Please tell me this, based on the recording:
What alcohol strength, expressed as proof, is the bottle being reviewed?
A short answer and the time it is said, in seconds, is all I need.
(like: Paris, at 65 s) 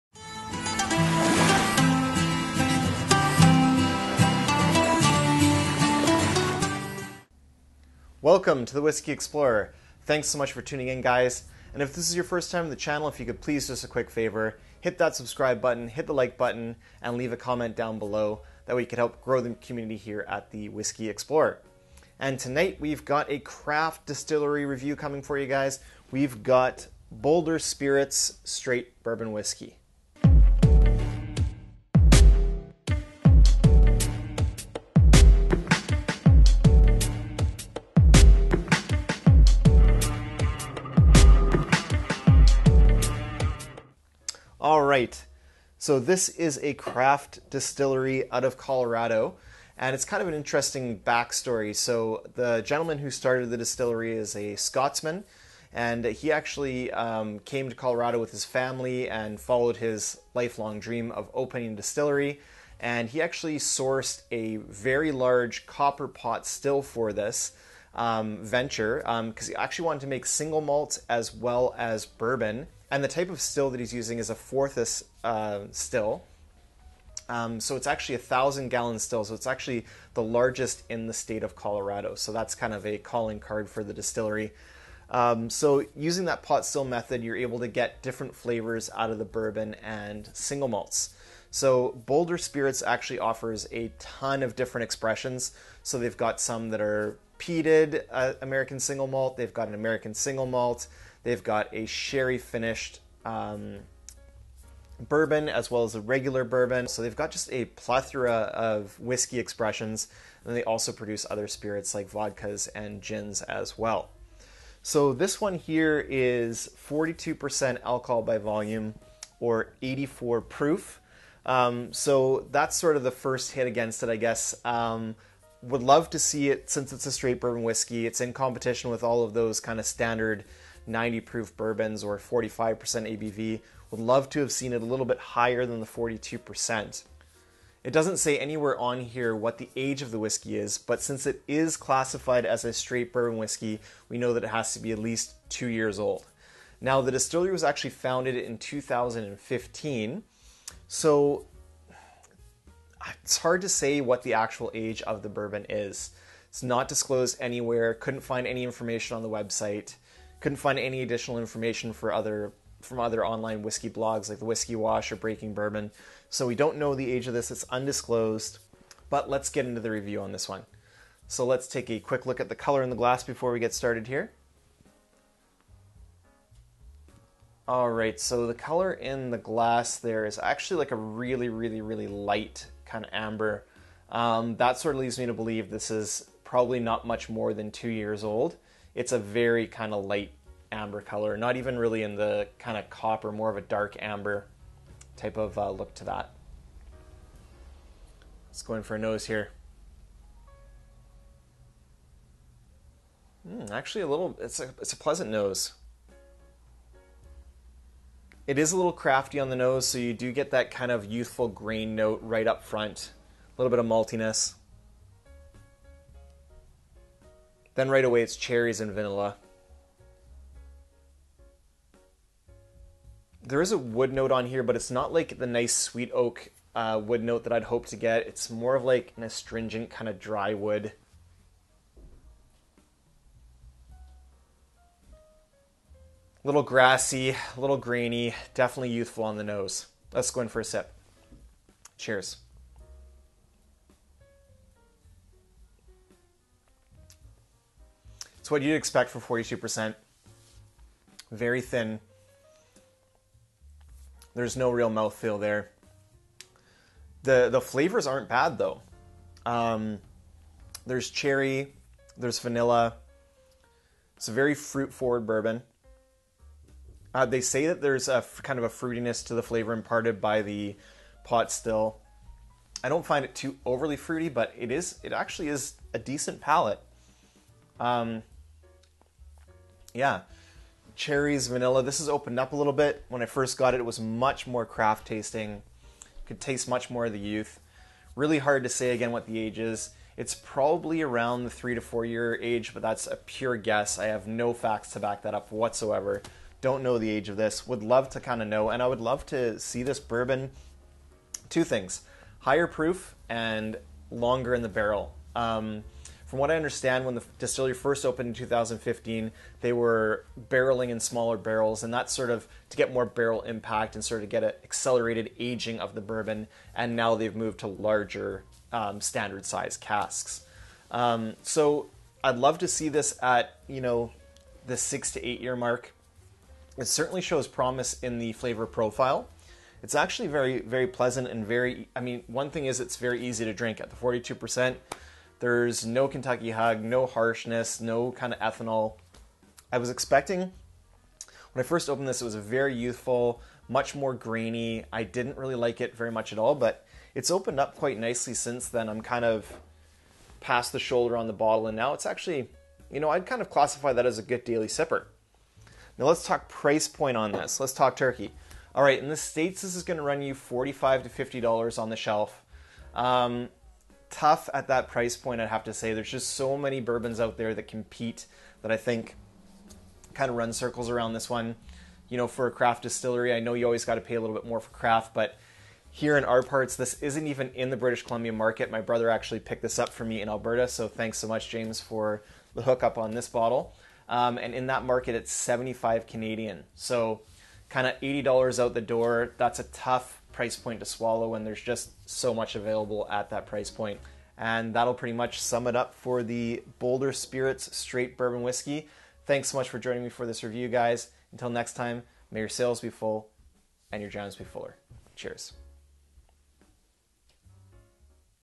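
84 proof, at 119 s.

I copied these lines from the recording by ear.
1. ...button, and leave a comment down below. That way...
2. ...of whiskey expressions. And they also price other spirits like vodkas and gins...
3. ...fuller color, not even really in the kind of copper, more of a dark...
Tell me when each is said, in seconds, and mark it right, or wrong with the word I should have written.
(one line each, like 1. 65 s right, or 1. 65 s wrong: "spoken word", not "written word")
1. 16 s right
2. 108 s wrong: "produce", not "price"
3. 190 s wrong: "amber", not "fuller".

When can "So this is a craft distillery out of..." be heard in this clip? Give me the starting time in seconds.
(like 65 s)
45 s.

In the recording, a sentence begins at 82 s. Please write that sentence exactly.
So that's kind of a calling card for the distillery.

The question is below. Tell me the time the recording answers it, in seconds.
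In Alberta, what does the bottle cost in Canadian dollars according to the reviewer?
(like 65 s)
385 s.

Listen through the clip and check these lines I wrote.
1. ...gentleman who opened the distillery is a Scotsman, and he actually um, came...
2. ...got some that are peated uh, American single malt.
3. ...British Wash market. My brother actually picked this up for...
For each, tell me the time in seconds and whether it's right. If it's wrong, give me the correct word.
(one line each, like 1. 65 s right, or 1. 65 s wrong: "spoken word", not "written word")
1. 52 s wrong: "started", not "opened"
2. 96 s right
3. 377 s wrong: "Columbia", not "Wash".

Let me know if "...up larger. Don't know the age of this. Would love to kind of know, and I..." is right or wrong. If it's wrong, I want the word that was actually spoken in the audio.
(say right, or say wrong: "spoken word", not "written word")
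wrong: "whatsoever", not "larger".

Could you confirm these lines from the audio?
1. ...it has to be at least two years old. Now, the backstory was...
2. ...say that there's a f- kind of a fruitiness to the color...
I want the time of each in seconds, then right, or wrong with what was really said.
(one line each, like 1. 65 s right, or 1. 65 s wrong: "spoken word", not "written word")
1. 144 s wrong: "distillery", not "backstory"
2. 267 s wrong: "flavor", not "color".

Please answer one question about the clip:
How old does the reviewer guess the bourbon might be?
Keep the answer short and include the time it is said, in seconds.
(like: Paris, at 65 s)
3 to 4 years, at 291 s.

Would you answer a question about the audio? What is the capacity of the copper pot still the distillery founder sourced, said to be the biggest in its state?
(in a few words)
1000 gallons.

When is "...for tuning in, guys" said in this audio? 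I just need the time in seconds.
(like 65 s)
10 s.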